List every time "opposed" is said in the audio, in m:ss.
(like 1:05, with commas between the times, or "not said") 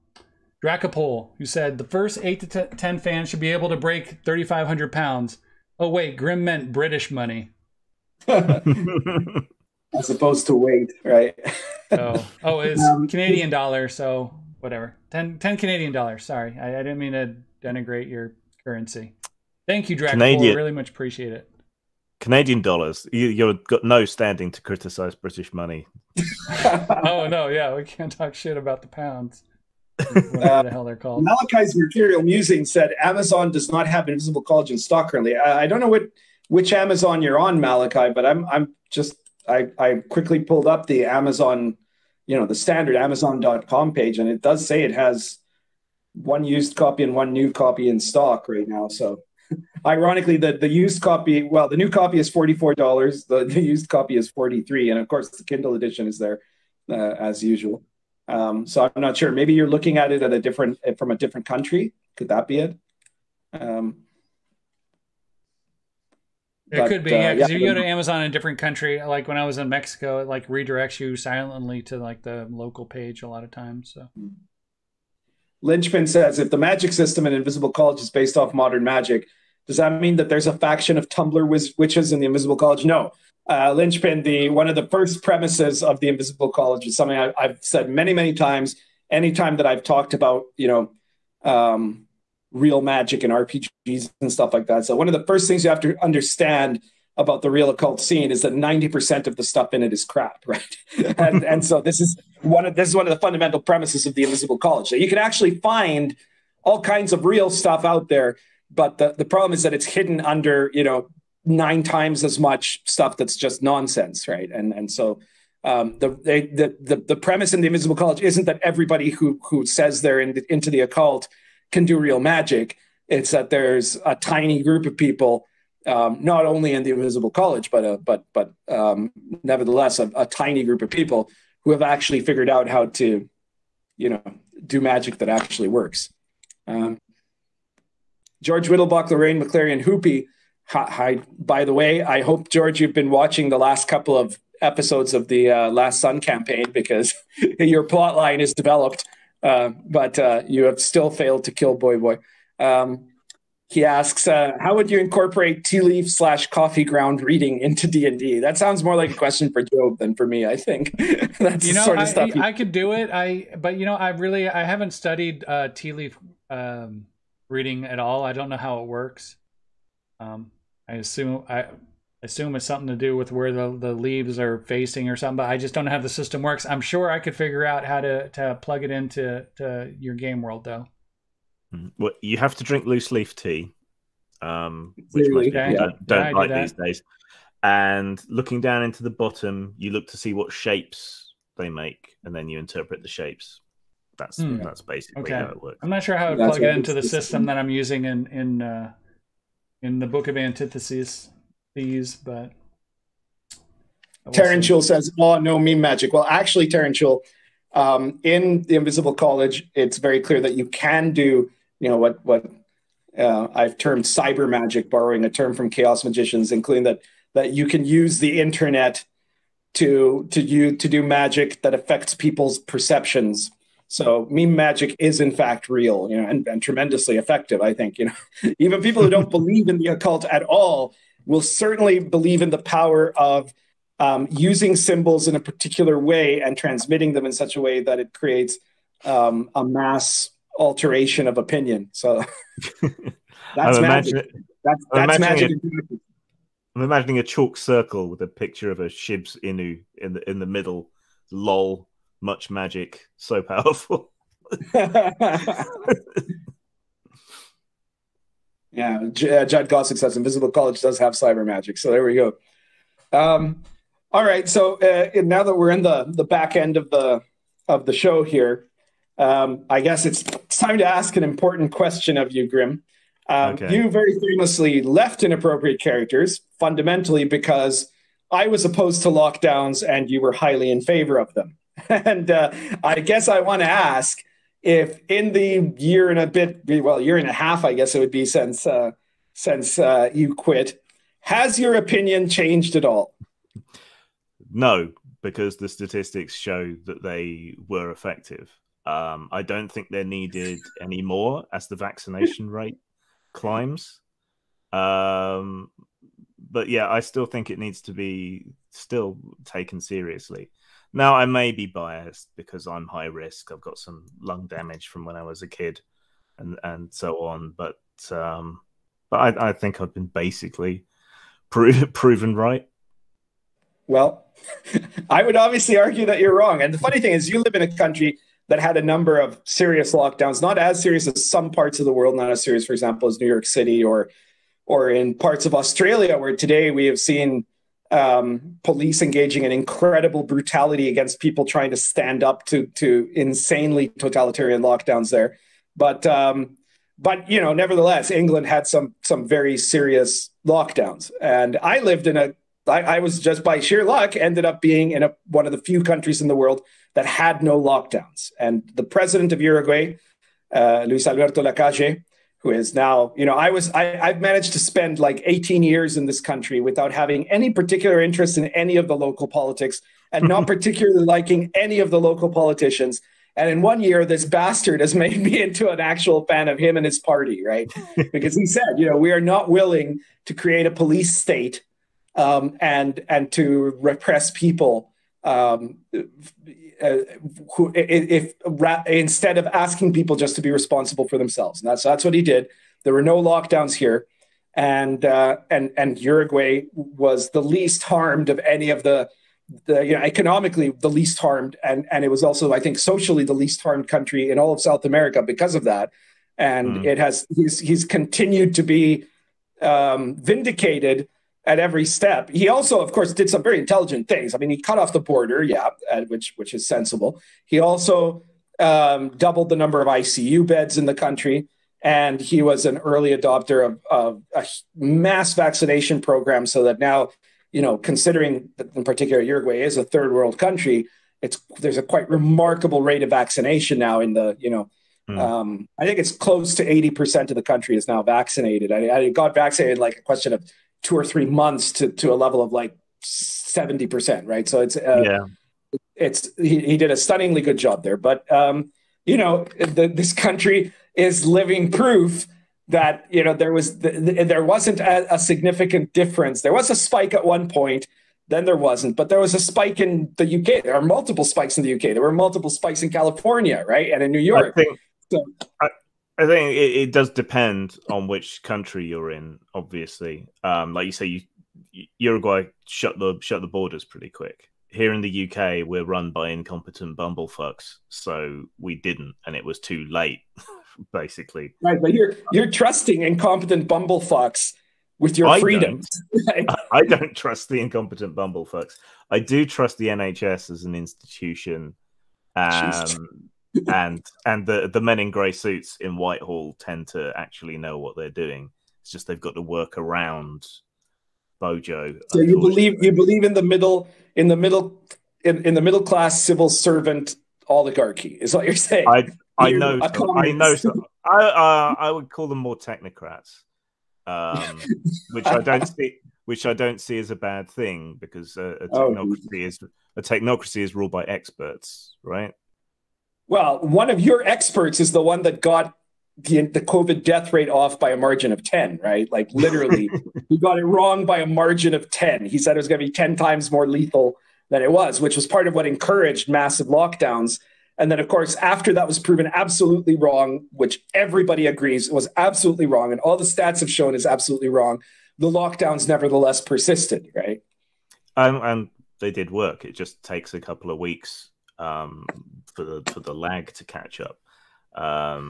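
0:10, 4:38.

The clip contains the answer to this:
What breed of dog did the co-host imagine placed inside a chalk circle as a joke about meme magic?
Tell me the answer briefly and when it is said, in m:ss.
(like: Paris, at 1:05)
Shiba Inu, at 4:08.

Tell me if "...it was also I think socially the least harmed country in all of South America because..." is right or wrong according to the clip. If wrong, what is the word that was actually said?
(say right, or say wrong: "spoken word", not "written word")
right.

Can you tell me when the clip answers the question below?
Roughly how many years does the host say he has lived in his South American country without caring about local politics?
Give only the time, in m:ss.
6:05.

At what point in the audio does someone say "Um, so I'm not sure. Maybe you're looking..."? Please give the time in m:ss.
0:58.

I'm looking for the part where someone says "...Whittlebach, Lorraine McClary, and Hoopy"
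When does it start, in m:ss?
2:18.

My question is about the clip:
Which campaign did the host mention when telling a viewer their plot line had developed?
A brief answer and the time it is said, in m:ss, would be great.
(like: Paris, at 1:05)
Last Sun, at 2:25.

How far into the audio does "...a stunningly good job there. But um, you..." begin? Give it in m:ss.
7:26.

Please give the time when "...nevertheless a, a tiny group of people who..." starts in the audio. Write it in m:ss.
2:09.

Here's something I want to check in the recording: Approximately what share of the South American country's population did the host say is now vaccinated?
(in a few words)
80%.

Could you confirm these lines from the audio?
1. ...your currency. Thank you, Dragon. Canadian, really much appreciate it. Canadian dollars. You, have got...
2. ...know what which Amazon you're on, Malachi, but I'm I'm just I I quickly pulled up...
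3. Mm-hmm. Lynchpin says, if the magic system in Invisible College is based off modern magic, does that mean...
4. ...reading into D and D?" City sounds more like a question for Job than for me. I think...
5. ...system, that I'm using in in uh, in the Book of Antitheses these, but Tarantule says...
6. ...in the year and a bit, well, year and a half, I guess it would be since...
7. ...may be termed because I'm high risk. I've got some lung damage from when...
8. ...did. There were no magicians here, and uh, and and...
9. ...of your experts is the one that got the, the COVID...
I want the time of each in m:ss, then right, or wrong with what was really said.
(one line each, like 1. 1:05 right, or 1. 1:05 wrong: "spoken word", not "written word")
1. 0:18 right
2. 0:35 right
3. 1:14 right
4. 2:37 wrong: "That", not "City"
5. 3:17 right
6. 4:45 right
7. 5:11 wrong: "biased", not "termed"
8. 6:32 wrong: "lockdowns", not "magicians"
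9. 8:43 right.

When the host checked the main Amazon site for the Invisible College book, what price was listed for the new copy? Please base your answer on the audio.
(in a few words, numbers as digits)
$44.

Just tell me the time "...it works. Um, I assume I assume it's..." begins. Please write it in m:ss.
2:48.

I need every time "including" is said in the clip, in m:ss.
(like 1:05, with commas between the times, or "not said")
3:36.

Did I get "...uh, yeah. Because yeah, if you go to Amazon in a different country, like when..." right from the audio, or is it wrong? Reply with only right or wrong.
right.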